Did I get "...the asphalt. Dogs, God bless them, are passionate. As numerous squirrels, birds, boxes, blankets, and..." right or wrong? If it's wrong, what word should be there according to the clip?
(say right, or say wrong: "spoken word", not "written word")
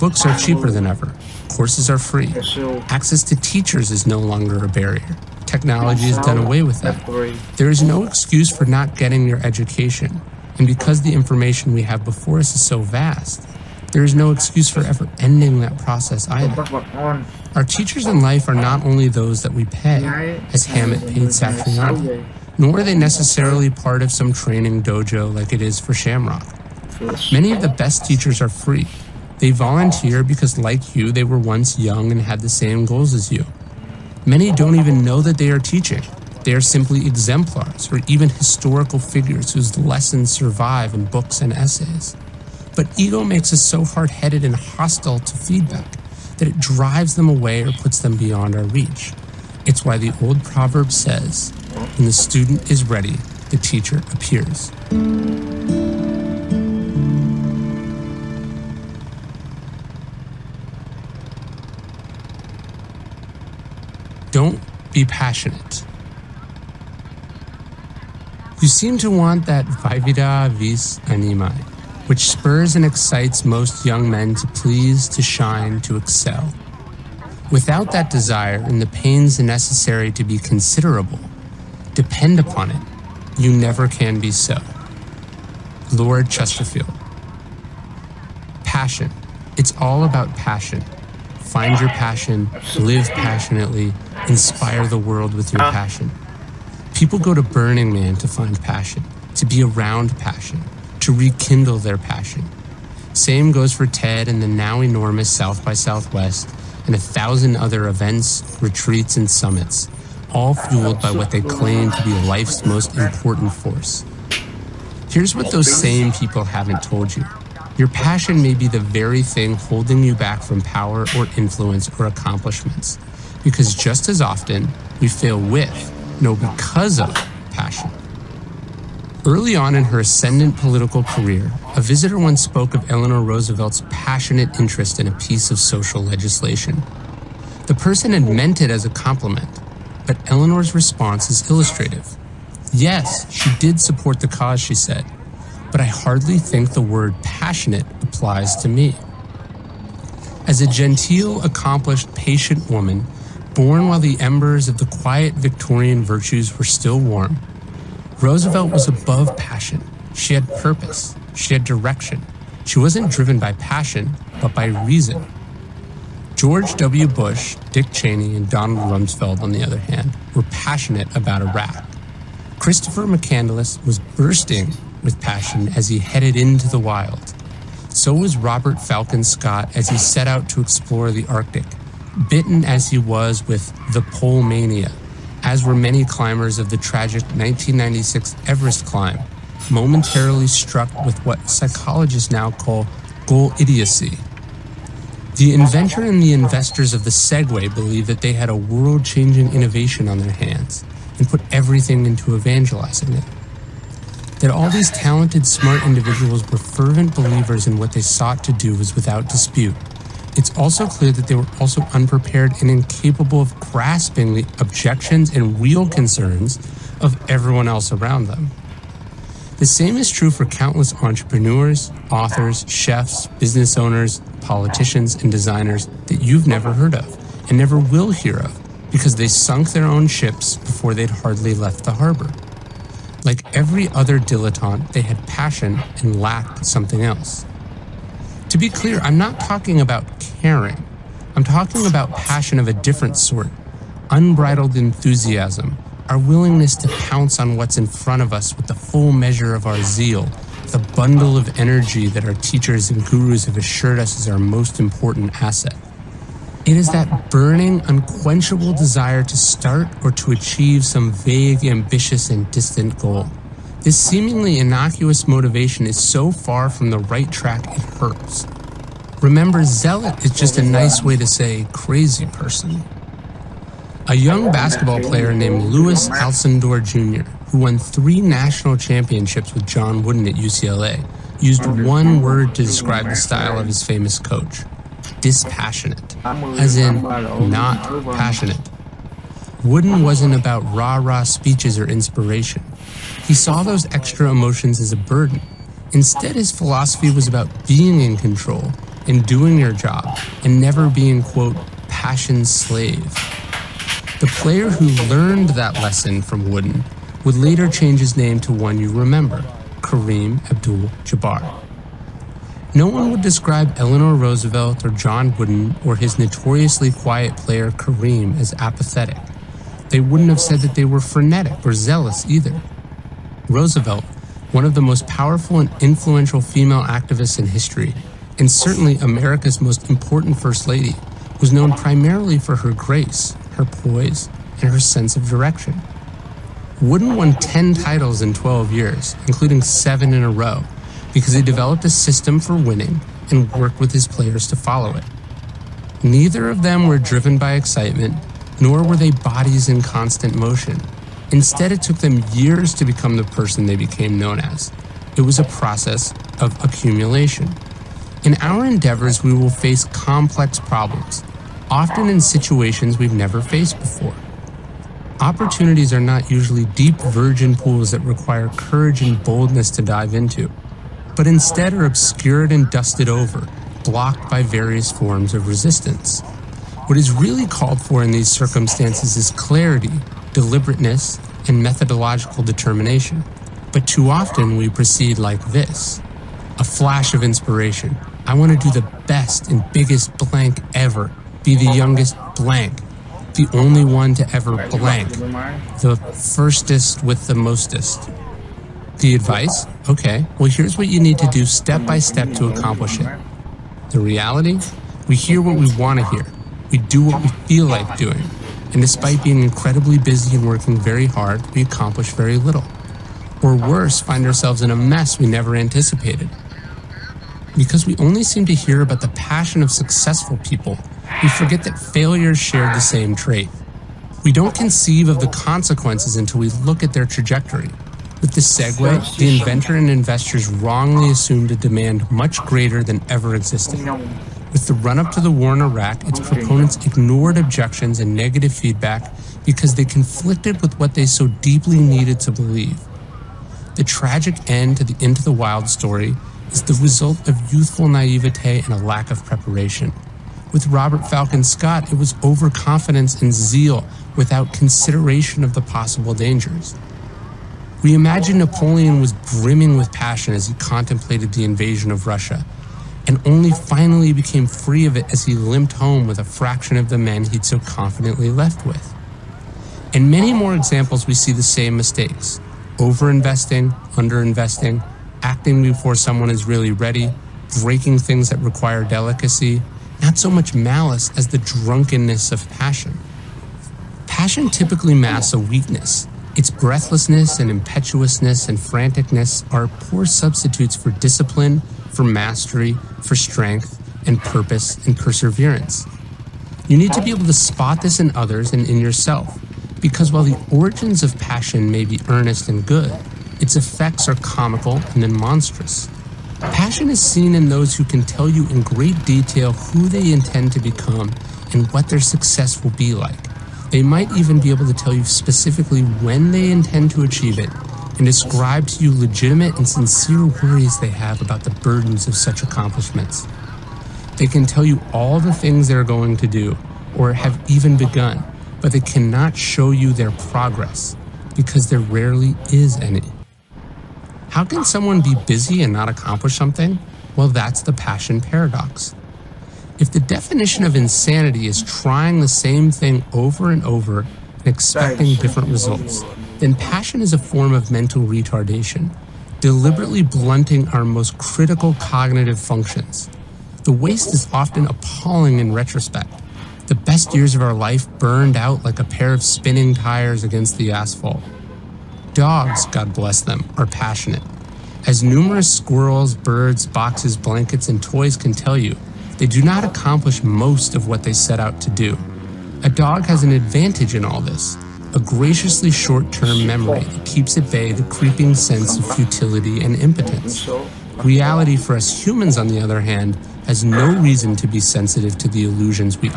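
right.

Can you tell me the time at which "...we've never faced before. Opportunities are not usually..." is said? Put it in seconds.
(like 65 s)
362 s.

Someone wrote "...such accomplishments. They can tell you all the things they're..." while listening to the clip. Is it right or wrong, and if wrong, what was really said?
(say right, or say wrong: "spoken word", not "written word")
right.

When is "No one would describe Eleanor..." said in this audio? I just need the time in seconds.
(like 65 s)
312 s.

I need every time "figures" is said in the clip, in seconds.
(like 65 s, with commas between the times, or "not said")
38 s.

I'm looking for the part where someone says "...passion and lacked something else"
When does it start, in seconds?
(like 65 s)
235 s.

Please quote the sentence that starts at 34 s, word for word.
Many don't even know that they are teaching.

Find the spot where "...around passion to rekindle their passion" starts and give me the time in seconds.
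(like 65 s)
99 s.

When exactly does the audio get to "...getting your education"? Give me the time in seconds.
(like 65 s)
8 s.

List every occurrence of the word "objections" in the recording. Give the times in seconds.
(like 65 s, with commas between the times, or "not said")
214 s, 437 s.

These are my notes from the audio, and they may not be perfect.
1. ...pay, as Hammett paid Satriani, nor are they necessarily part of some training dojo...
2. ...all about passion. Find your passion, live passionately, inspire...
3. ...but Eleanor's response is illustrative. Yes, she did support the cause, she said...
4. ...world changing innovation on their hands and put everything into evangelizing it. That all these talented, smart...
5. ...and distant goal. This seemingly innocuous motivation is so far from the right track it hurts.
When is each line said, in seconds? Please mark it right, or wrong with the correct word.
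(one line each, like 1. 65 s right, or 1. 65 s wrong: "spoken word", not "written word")
1. 19 s right
2. 89 s right
3. 140 s right
4. 198 s right
5. 262 s right.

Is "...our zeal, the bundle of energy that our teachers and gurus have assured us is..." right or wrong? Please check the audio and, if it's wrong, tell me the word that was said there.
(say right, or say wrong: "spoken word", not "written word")
right.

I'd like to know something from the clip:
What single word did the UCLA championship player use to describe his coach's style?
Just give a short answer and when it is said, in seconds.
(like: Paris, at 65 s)
dispassionate, at 285 s.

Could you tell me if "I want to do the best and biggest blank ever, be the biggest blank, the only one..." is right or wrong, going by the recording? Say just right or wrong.
wrong.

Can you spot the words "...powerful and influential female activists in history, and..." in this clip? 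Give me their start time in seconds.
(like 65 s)
325 s.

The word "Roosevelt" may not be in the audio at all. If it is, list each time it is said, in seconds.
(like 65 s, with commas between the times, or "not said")
133 s, 158 s, 314 s, 323 s.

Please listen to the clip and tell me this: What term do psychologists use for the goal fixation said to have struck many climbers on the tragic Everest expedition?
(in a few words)
goalodicy.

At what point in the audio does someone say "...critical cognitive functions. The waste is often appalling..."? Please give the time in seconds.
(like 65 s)
551 s.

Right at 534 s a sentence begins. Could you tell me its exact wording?
How can someone be busy and not accomplish something?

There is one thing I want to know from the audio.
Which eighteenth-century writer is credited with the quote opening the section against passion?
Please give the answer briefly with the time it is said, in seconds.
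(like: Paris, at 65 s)
Lord Chesterfield, at 85 s.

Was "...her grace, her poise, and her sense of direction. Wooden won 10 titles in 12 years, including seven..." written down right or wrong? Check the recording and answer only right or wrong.
right.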